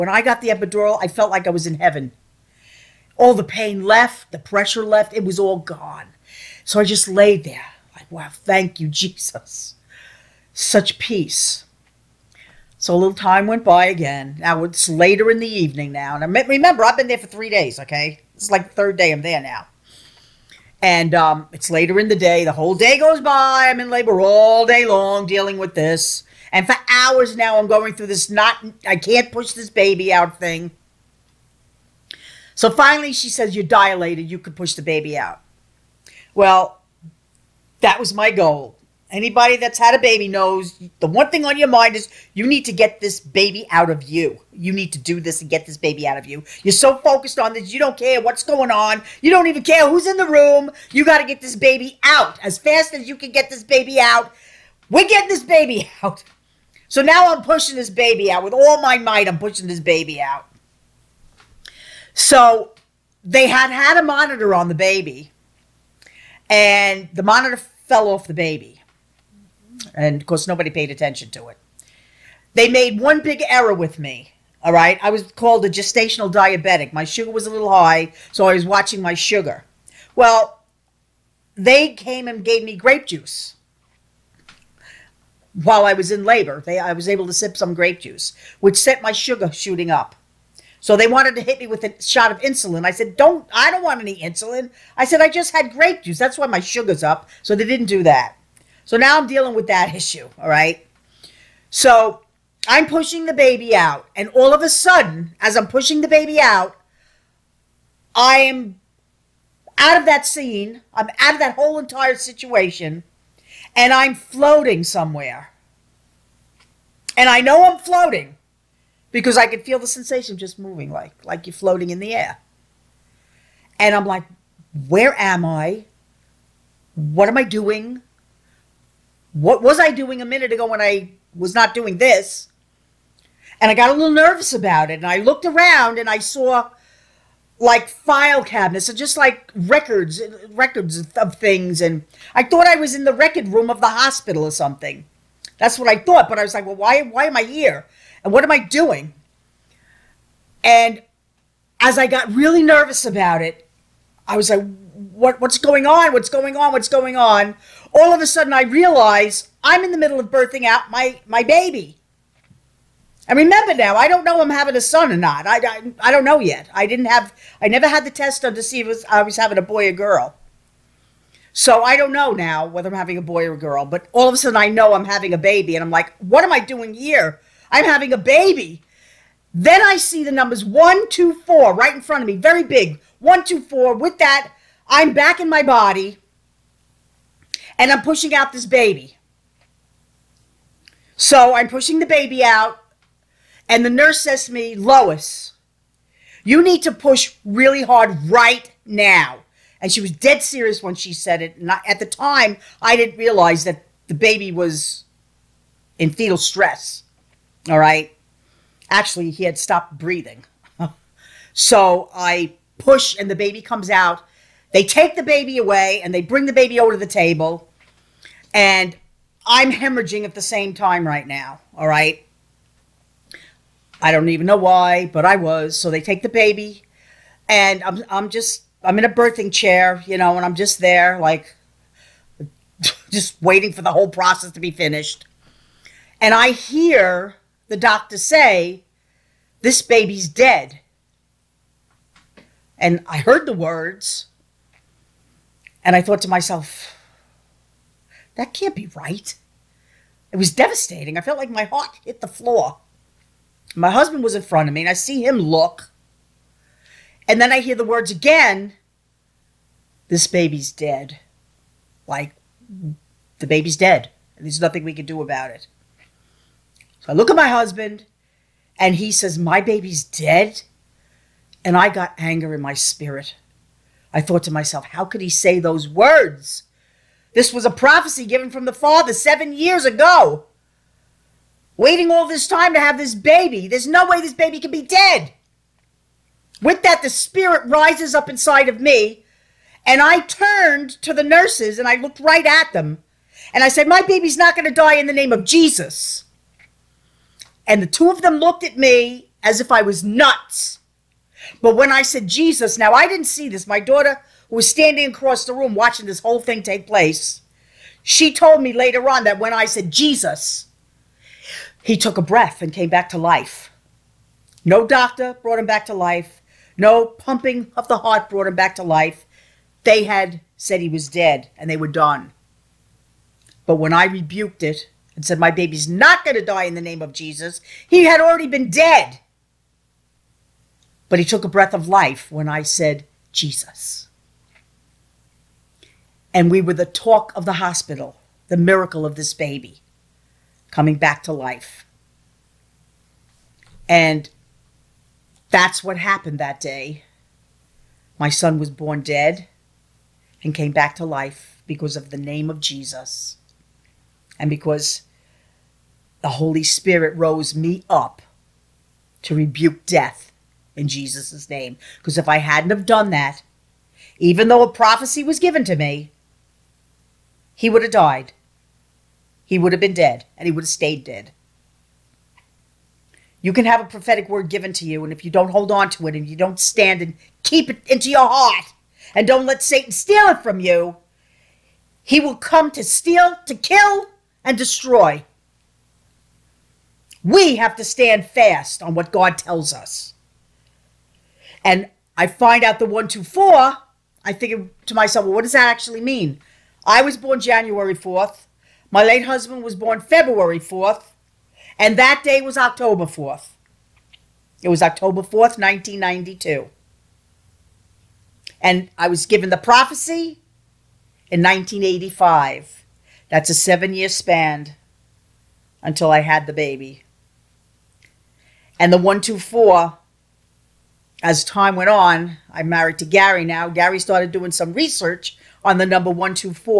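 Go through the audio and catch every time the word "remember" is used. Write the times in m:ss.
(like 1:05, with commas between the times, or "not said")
0:16, 2:43.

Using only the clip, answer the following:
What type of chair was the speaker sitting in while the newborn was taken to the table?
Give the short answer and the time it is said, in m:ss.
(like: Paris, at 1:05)
birthing chair, at 3:49.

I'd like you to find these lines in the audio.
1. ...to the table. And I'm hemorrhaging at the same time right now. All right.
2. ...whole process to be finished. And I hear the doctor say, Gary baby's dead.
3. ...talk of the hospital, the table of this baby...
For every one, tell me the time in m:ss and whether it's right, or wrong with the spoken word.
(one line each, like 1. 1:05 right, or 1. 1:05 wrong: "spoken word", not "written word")
1. 3:36 right
2. 3:53 wrong: "This", not "Gary"
3. 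5:36 wrong: "miracle", not "table".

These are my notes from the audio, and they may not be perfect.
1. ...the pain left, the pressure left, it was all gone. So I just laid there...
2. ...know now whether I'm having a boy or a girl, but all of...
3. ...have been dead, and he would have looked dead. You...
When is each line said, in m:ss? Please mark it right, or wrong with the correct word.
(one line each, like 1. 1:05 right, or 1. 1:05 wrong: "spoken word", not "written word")
1. 0:03 right
2. 2:52 right
3. 6:09 wrong: "stayed", not "looked".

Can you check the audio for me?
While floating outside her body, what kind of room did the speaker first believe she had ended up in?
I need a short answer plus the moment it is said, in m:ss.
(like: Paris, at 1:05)
record room, at 2:23.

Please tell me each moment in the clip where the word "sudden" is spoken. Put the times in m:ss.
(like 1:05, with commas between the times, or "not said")
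1:44, 2:38, 2:54.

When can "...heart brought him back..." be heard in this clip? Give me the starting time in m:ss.
5:17.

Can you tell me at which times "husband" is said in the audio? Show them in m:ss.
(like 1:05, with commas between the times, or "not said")
4:13, 4:27, 6:39.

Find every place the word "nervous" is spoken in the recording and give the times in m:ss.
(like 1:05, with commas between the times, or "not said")
2:14, 2:32.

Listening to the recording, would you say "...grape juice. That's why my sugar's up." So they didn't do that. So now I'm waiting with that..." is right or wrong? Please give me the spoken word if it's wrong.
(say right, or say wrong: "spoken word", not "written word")
wrong: "dealing", not "waiting".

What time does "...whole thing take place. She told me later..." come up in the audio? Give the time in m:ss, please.
5:06.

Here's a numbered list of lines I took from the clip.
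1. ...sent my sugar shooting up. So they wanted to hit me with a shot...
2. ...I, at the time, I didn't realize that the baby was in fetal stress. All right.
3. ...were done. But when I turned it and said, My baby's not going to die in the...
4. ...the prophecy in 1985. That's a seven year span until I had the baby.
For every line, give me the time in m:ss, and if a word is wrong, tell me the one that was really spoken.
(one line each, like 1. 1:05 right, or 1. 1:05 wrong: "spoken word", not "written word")
1. 1:28 right
2. 3:21 right
3. 5:21 wrong: "rebuked", not "turned"
4. 6:49 right.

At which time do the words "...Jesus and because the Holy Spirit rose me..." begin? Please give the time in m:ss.
5:52.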